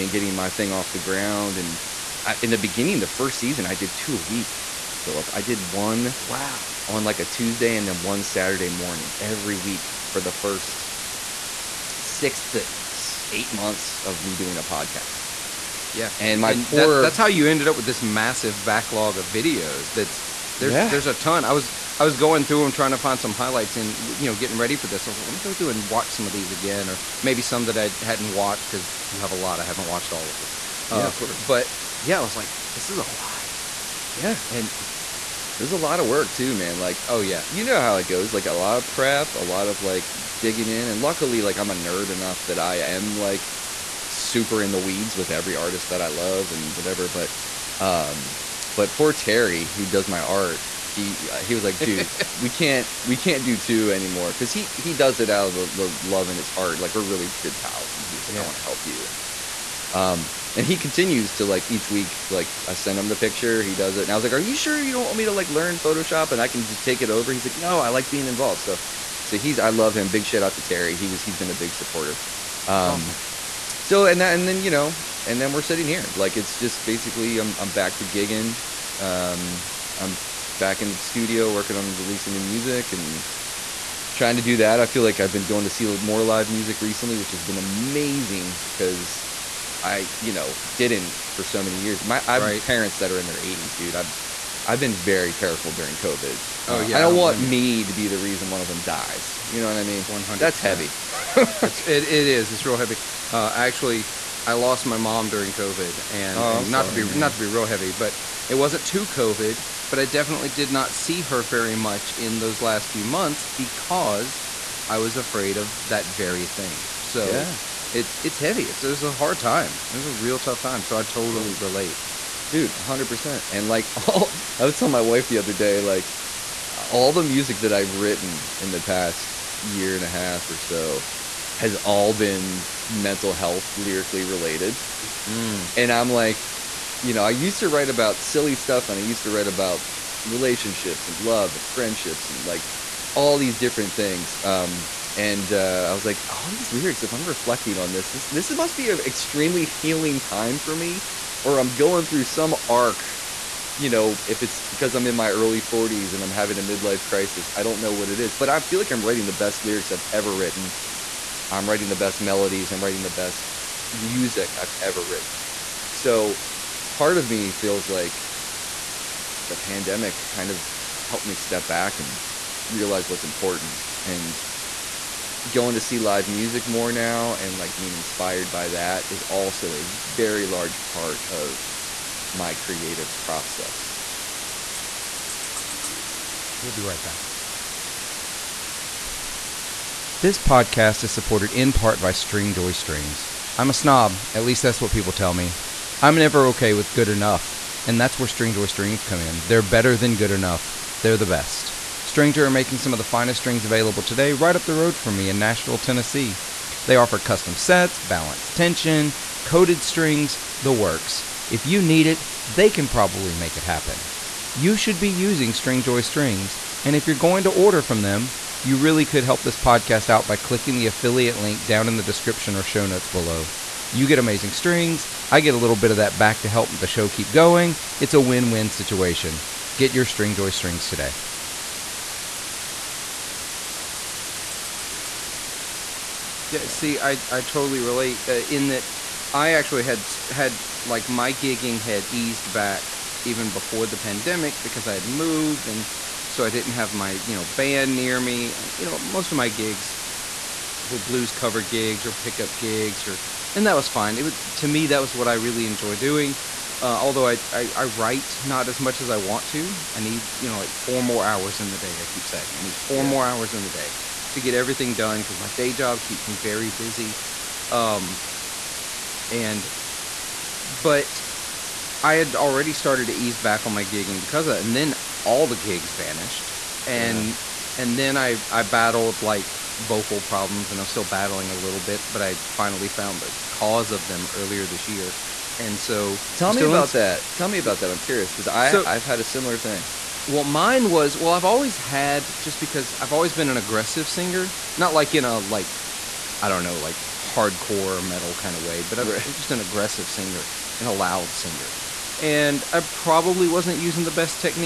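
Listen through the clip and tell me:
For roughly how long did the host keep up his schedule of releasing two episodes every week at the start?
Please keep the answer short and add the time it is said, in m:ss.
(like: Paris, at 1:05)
6 to 8 months, at 0:11.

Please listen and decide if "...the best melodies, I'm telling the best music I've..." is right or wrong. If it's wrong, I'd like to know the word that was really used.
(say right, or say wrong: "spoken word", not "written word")
wrong: "writing", not "telling".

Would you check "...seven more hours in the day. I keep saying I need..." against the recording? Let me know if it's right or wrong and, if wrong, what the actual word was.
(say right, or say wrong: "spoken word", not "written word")
wrong: "four", not "seven".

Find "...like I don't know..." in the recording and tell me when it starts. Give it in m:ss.
4:55.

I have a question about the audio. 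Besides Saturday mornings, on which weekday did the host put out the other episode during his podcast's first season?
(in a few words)
Tuesday.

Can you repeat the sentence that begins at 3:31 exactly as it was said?
If you need it, they can probably make it happen you should be using Stringjoy Strings.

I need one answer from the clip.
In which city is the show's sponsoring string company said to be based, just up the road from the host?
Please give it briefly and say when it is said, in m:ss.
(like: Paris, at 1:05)
Nashville, at 3:25.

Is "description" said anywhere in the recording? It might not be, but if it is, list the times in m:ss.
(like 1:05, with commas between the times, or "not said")
3:42.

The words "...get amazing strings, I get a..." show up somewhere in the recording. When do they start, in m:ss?
3:44.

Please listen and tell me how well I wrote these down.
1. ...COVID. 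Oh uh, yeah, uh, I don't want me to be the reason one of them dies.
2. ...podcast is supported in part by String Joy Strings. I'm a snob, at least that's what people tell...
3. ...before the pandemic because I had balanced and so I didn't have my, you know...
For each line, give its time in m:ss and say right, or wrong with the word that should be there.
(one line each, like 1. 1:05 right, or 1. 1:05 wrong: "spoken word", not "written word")
1. 1:35 right
2. 3:10 right
3. 4:03 wrong: "moved", not "balanced".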